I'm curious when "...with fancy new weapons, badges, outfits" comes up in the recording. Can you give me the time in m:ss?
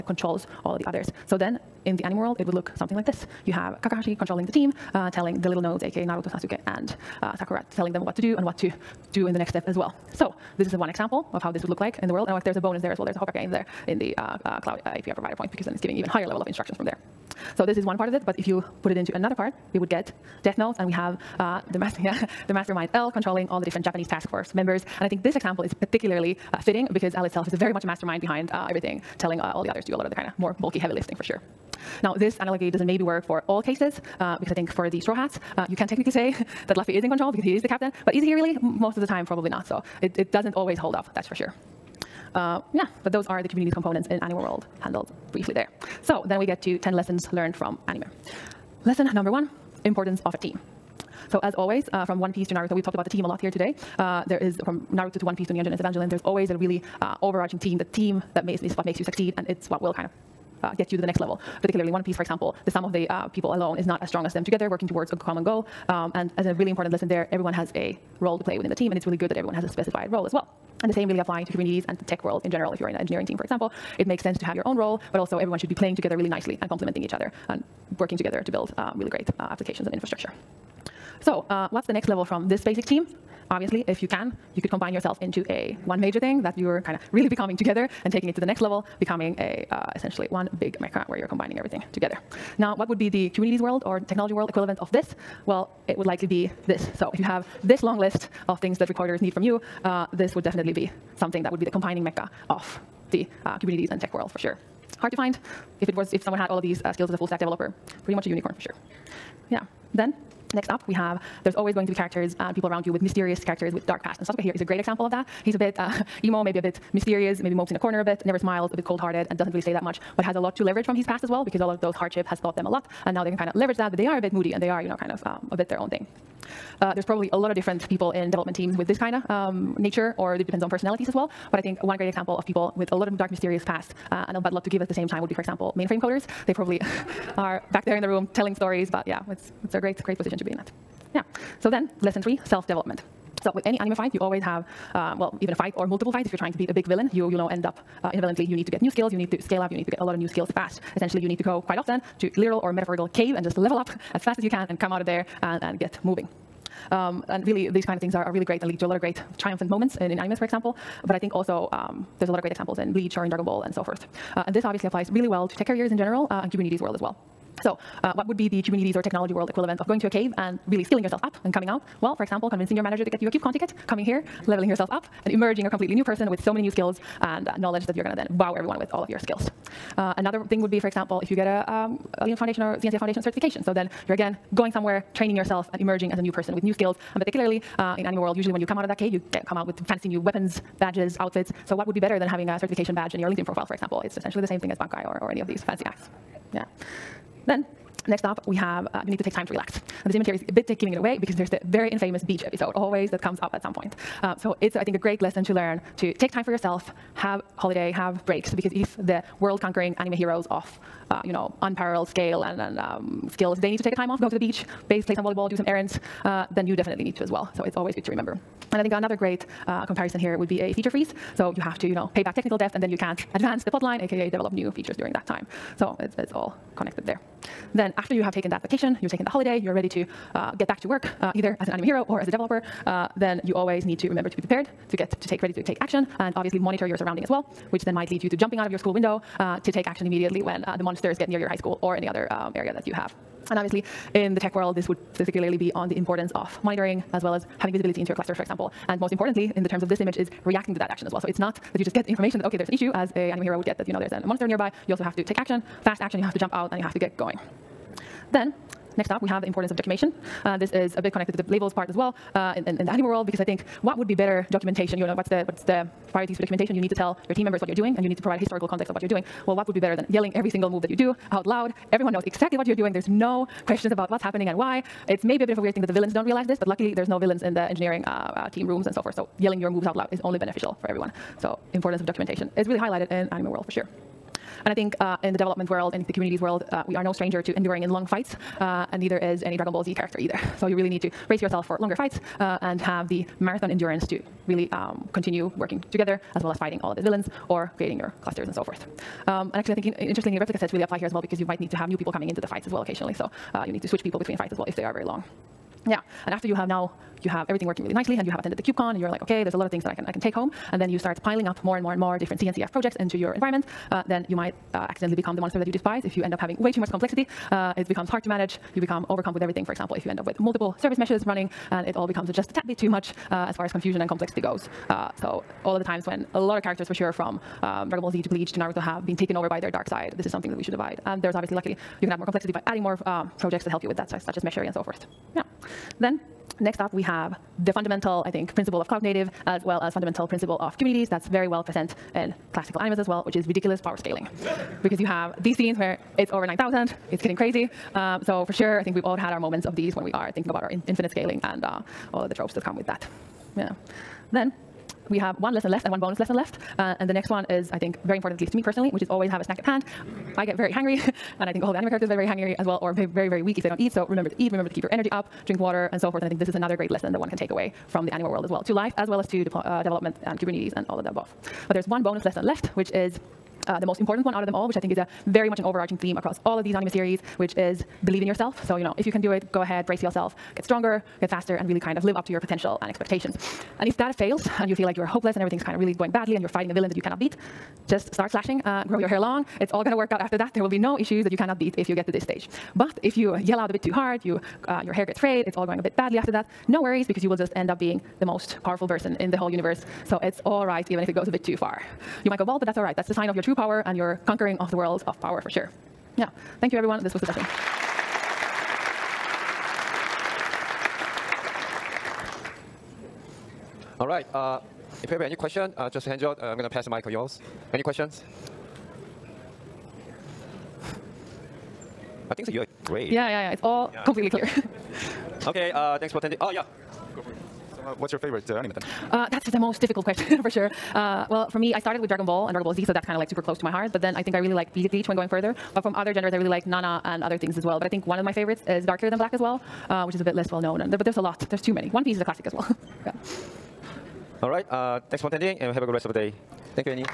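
3:09.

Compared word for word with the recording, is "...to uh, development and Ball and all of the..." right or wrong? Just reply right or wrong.
wrong.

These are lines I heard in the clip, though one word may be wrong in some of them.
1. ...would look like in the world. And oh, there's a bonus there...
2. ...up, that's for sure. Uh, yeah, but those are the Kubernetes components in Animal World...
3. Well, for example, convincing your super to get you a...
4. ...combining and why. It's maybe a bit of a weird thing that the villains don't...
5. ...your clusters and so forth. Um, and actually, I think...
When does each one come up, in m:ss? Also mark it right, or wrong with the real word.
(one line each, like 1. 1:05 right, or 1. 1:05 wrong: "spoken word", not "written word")
1. 0:11 right
2. 0:40 right
3. 2:52 wrong: "manager", not "super"
4. 4:34 wrong: "happening", not "combining"
5. 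4:58 right.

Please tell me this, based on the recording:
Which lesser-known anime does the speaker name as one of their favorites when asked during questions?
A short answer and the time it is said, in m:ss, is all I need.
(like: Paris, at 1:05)
Darker Than Black, at 7:18.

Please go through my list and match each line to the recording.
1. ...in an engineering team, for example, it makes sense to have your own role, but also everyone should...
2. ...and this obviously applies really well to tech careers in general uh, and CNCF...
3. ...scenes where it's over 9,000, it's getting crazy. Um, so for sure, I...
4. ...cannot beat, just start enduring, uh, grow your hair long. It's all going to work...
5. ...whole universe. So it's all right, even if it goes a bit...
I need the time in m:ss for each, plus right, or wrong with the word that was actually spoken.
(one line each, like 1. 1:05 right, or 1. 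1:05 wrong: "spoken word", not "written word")
1. 1:12 right
2. 2:44 wrong: "Kubernetes", not "CNCF"
3. 5:45 right
4. 6:27 wrong: "flashing", not "enduring"
5. 6:39 right.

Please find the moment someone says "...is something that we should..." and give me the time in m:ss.
5:30.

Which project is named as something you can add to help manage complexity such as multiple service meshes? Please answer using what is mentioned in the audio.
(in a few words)
Meshery.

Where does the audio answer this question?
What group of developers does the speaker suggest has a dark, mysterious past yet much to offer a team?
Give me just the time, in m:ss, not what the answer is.
2:15.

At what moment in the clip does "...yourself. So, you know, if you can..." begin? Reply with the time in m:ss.
6:18.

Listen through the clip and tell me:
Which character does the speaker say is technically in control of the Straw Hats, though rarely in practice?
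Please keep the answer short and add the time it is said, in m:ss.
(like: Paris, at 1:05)
Luffy, at 0:36.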